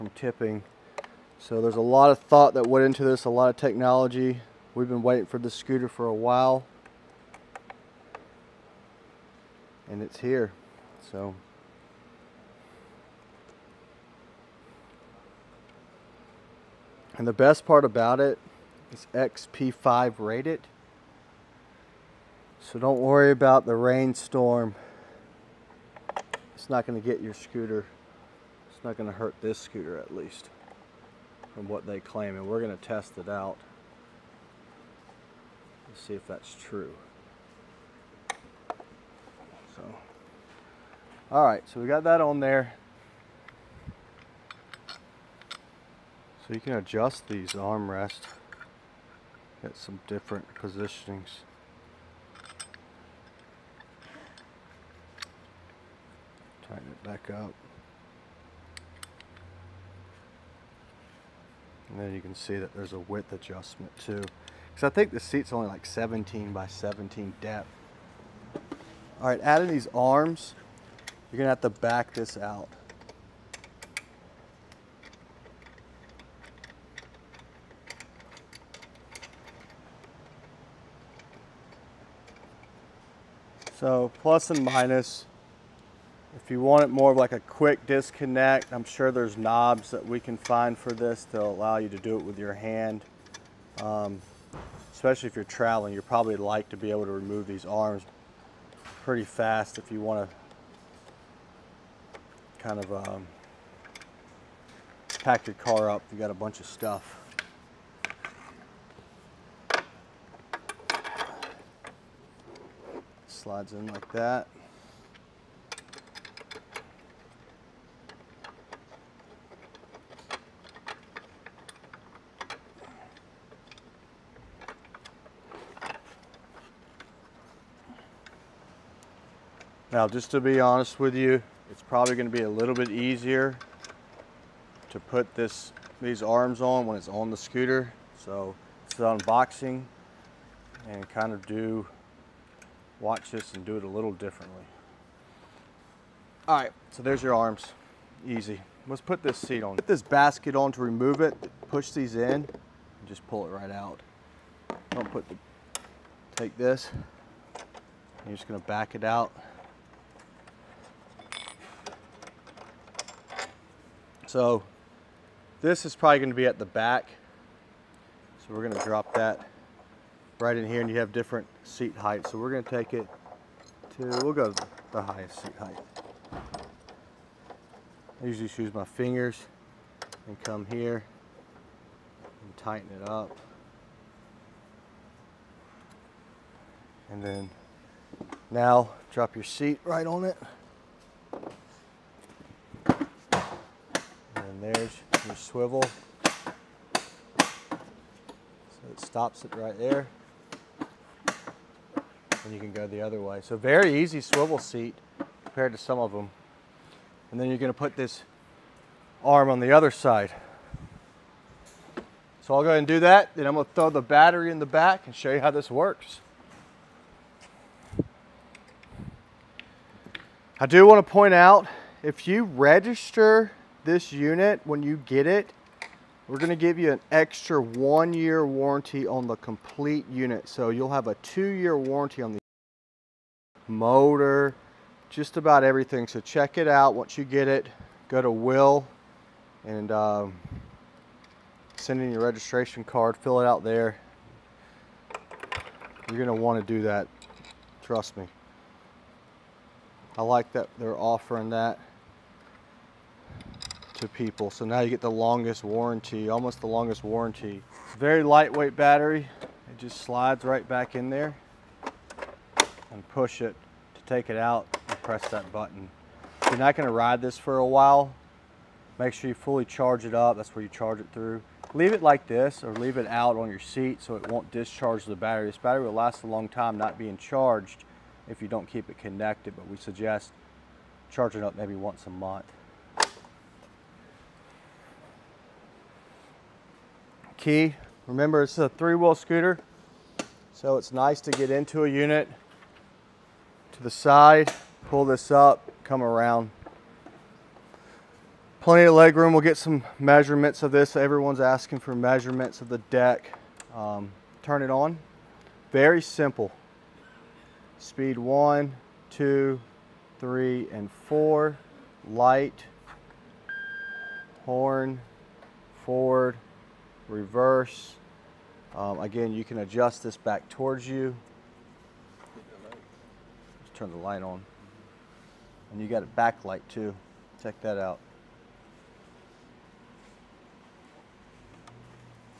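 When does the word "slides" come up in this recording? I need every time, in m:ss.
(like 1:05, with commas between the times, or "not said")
1:53, 4:20.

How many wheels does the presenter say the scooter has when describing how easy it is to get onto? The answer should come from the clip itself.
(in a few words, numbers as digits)
3.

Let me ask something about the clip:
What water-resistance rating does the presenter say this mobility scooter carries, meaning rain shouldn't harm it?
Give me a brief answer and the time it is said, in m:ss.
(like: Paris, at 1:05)
IPX5, at 0:19.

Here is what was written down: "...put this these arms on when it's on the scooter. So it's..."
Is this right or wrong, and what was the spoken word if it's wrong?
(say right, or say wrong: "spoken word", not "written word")
right.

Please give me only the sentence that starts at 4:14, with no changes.
So now you get the longest warranty, almost the longest warranty.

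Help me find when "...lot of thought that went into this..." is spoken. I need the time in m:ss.
0:01.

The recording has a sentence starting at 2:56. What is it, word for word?
I usually just use my fingers and come here and tighten it up.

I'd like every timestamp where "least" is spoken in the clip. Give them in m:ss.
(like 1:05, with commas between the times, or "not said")
0:30.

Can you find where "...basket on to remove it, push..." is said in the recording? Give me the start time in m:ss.
2:30.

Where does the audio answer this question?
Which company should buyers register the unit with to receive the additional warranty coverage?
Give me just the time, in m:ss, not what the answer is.
3:58.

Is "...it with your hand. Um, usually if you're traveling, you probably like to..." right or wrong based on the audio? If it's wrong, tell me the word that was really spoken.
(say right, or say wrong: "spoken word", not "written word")
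wrong: "especially", not "usually".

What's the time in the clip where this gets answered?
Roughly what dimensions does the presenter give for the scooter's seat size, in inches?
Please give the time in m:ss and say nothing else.
1:05.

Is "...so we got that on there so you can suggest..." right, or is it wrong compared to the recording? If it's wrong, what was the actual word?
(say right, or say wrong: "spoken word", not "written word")
wrong: "adjust", not "suggest".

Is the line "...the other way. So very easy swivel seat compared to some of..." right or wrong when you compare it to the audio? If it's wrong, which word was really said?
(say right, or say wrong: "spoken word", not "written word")
right.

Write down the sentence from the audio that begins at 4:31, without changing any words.
Leave it like this or leave it out on your seat so it won't discharge the battery.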